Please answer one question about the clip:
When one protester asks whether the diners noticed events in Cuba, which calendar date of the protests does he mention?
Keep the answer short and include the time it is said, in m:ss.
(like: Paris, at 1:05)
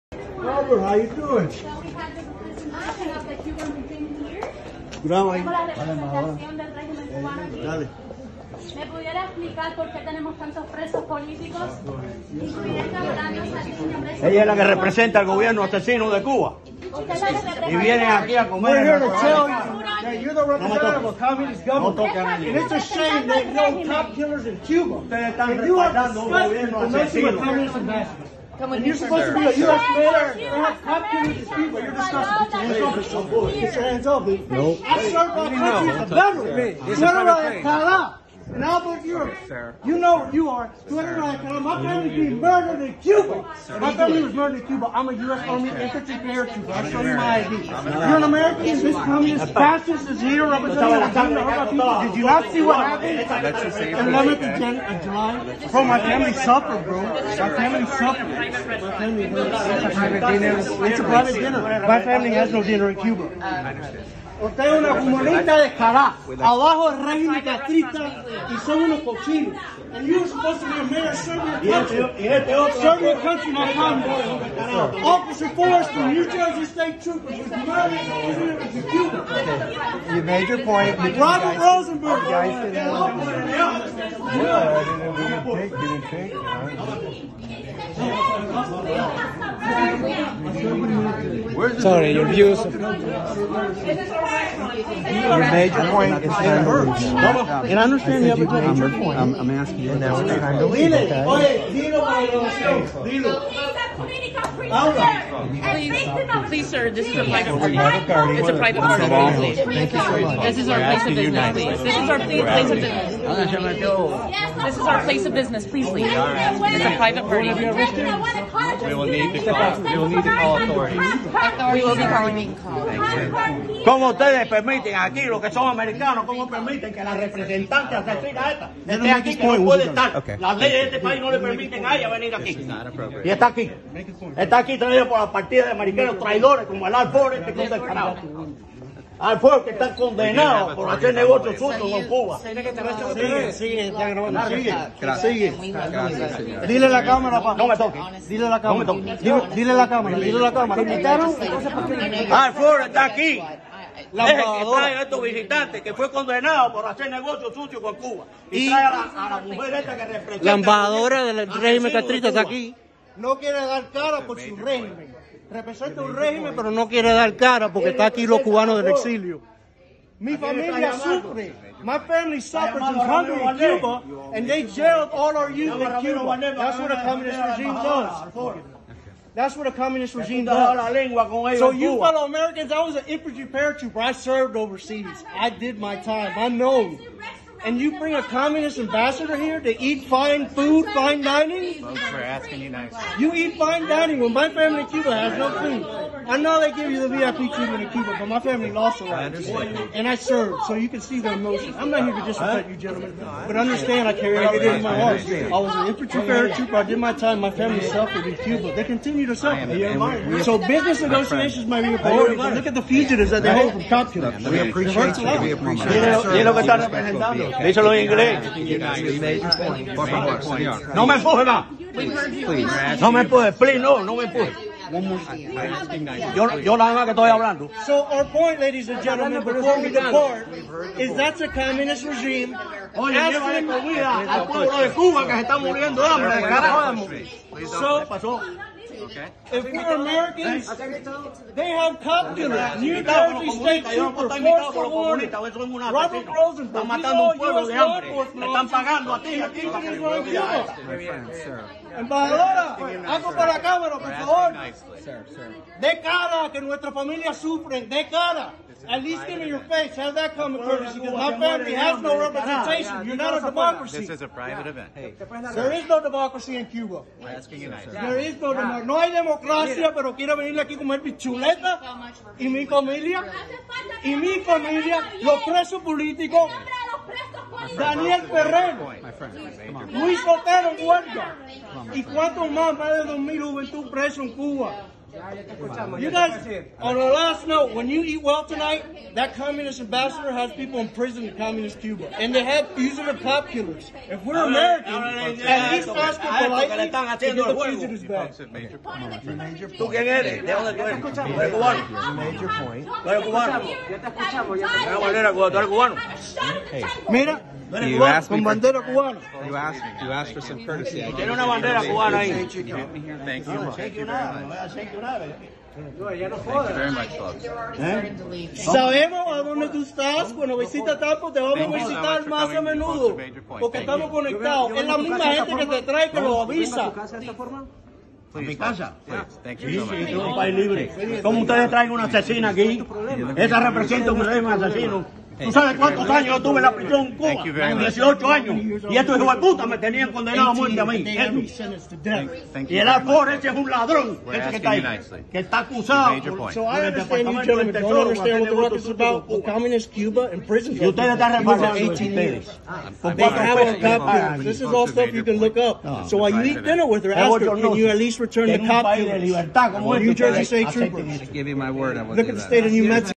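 11th of July, at 0:53.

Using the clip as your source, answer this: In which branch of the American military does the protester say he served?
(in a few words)
U.S. Army.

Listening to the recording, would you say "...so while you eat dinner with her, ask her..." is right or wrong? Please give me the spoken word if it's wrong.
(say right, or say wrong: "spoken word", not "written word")
right.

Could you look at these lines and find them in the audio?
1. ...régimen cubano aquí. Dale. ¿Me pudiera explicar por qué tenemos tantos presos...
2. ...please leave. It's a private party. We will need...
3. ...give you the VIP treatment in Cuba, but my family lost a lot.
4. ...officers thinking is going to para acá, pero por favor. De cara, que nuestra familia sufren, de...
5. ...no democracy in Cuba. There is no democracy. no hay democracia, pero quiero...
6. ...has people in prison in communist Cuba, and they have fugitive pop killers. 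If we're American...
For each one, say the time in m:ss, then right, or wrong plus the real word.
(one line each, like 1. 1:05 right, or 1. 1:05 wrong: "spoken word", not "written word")
1. 0:06 right
2. 1:55 right
3. 3:16 right
4. 4:08 right
5. 4:25 right
6. 4:50 right.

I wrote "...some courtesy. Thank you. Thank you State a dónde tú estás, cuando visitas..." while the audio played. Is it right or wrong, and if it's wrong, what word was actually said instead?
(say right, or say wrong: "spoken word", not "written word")
wrong: "Sabemos", not "State".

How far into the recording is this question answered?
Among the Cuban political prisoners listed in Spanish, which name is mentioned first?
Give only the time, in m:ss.
4:37.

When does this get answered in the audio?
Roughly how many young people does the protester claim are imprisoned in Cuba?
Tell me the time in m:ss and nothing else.
4:42.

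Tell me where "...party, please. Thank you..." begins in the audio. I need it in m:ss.
1:48.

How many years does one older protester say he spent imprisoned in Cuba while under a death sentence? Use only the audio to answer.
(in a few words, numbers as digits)
18 years.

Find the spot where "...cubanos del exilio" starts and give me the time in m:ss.
2:48.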